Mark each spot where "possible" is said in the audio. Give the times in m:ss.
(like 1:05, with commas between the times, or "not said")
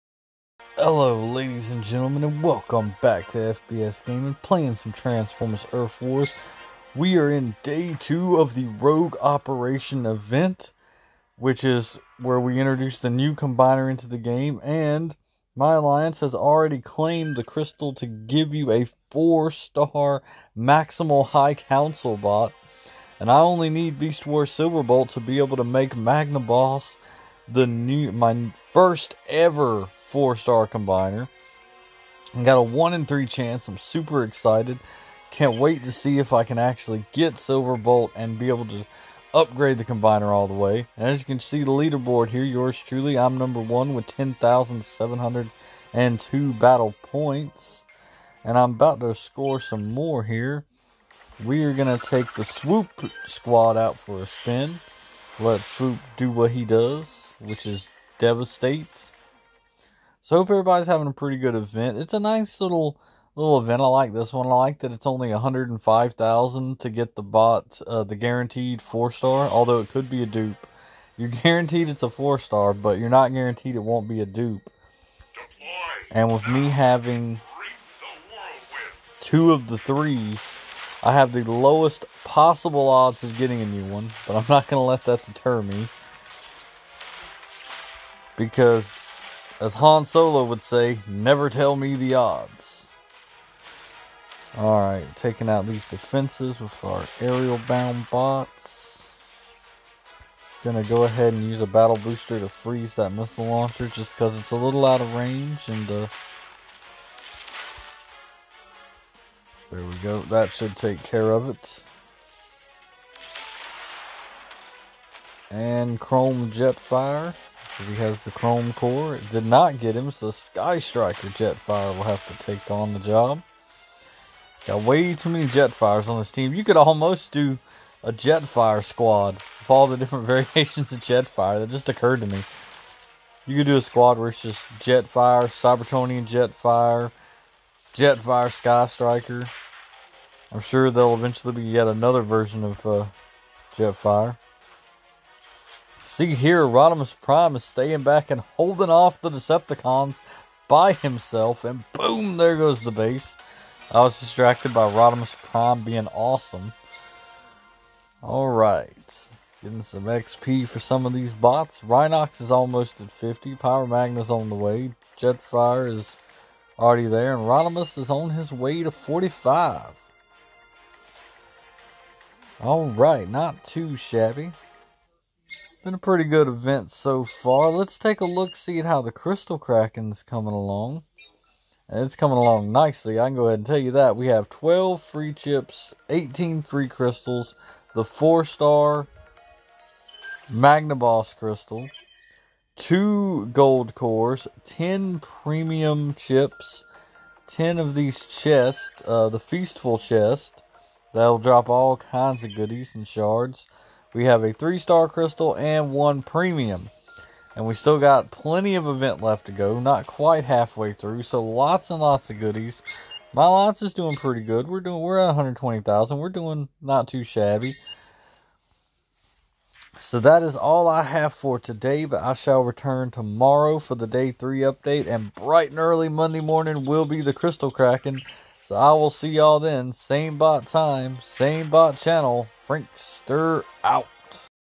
1:22.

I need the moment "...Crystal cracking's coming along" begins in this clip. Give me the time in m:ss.
2:59.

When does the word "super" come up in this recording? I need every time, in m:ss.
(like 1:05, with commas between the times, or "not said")
0:33.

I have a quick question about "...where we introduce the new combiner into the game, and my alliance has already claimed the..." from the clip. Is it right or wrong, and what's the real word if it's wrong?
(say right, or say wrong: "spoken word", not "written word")
right.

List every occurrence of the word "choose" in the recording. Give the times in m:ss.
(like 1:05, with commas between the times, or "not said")
not said.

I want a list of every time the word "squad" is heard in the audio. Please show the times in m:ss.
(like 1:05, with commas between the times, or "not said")
0:53, 2:08, 2:13.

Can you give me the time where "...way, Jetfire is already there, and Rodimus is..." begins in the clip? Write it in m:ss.
2:44.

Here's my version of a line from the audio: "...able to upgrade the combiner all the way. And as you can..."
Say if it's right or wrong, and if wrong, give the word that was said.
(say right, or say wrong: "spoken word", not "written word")
right.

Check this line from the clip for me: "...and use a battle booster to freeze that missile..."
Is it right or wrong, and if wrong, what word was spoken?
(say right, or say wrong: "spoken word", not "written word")
right.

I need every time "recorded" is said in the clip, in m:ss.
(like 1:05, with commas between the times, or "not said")
not said.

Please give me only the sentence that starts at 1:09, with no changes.
Although it could be a dupe.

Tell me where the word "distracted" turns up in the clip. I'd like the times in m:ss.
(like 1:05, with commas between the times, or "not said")
2:34.